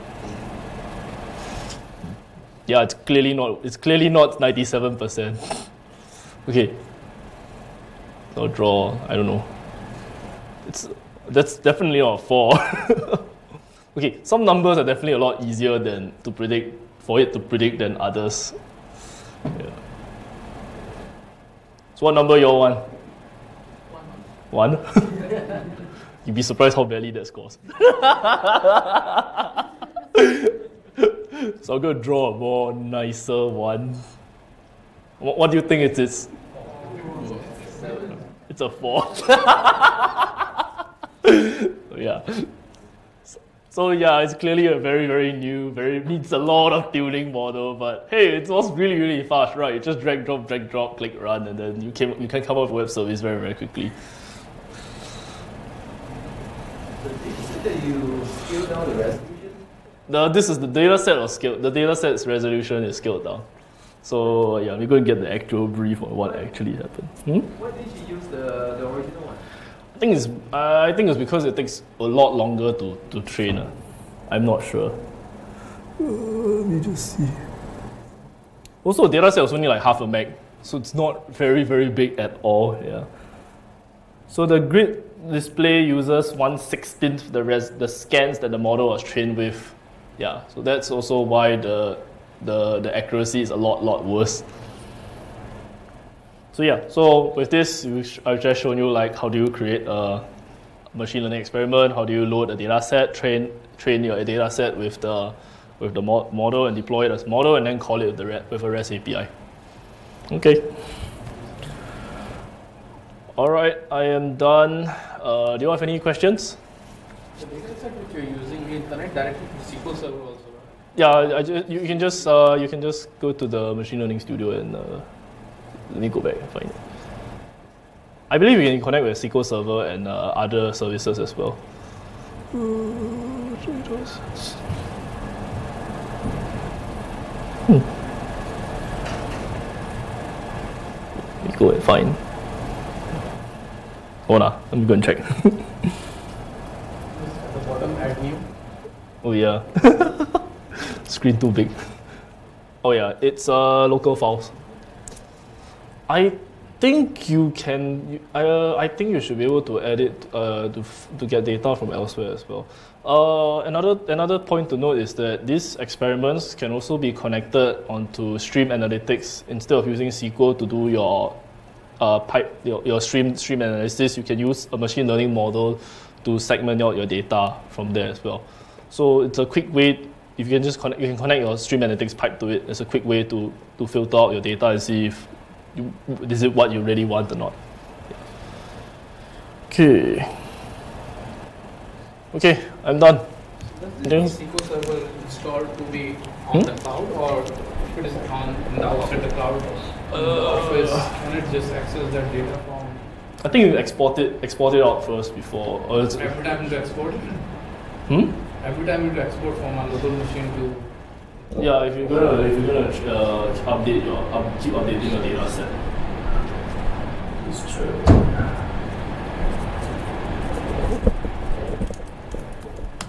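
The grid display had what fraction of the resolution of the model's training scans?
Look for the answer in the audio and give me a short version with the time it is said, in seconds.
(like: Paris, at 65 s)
one sixteenth, at 86 s.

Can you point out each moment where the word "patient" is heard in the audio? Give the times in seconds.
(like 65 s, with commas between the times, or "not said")
not said.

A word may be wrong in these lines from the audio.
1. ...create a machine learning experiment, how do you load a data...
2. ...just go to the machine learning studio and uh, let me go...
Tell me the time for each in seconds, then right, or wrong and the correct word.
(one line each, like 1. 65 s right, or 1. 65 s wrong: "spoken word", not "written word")
1. 99 s right
2. 122 s right.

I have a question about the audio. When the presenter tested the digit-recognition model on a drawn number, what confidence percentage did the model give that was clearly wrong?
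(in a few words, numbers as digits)
97%.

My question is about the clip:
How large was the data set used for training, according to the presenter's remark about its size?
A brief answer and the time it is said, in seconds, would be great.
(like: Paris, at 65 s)
half a meg, at 79 s.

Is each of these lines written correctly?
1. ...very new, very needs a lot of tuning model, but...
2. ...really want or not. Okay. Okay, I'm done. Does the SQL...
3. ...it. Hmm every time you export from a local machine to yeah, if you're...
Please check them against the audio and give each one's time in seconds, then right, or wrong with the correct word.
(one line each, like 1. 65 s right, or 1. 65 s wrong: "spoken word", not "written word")
1. 45 s right
2. 186 s right
3. 207 s right.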